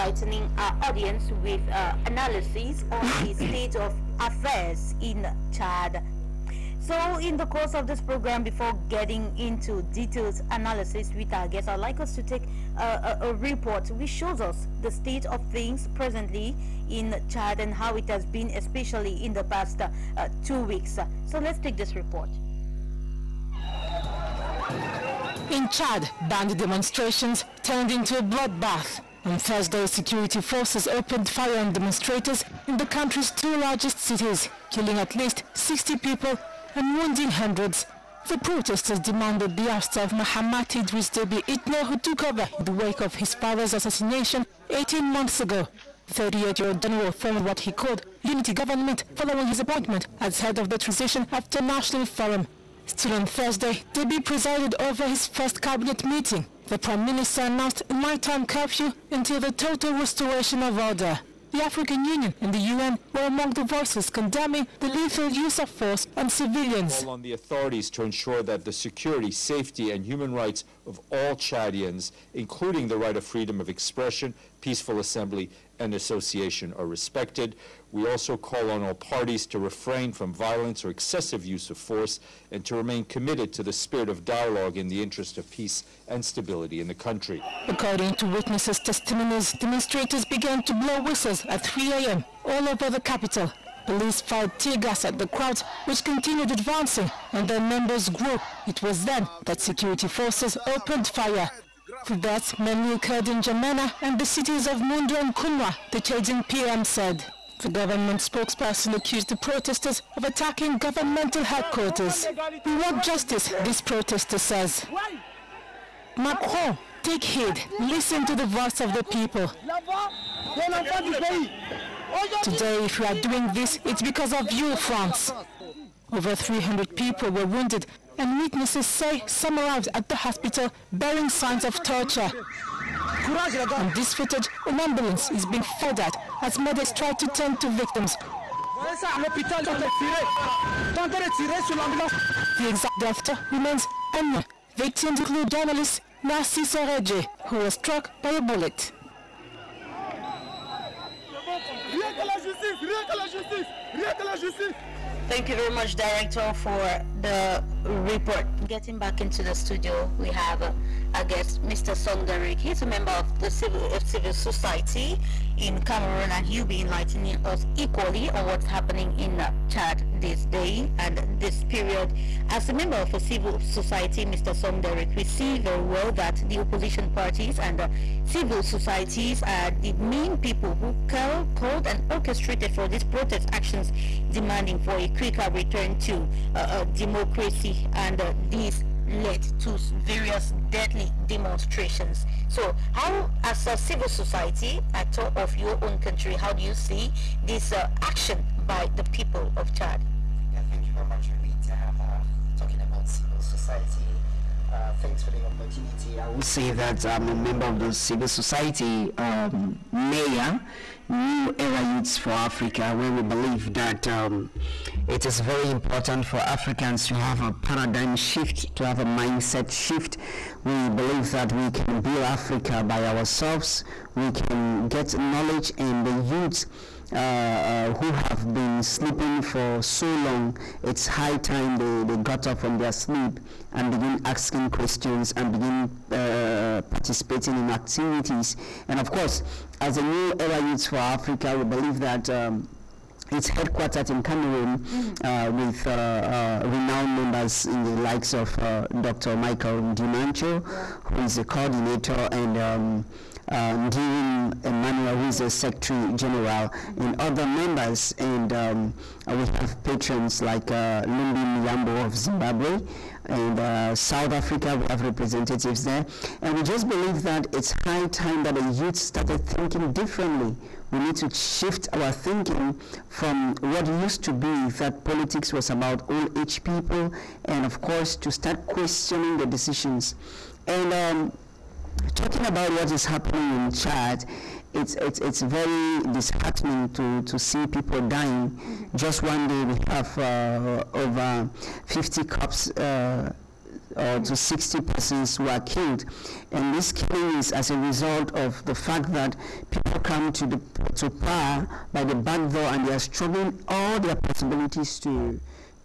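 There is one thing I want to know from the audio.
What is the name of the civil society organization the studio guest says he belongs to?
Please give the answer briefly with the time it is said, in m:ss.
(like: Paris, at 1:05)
New Era Youths for Africa, at 3:31.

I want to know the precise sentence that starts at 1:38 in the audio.
It was then that security forces opened fire.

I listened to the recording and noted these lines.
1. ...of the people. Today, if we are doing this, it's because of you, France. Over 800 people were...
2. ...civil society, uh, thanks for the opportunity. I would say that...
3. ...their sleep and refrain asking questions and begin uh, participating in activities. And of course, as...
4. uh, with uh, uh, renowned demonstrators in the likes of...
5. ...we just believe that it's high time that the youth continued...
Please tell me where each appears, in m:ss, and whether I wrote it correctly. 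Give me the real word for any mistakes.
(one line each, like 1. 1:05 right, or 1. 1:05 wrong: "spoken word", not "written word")
1. 1:58 wrong: "300", not "800"
2. 3:23 right
3. 3:52 wrong: "begin", not "refrain"
4. 4:05 wrong: "members", not "demonstrators"
5. 4:26 wrong: "started", not "continued".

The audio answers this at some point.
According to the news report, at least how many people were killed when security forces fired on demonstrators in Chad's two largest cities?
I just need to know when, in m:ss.
0:34.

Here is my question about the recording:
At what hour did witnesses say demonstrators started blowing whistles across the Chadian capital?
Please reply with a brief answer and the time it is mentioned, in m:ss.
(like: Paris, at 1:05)
3 a.m., at 1:31.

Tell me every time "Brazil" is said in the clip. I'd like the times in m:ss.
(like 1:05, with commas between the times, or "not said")
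not said.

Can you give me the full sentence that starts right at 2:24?
Victims include journalists Narcisse Oredje, who was struck by a bullet.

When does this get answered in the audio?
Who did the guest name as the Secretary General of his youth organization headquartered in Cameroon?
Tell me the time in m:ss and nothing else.
4:13.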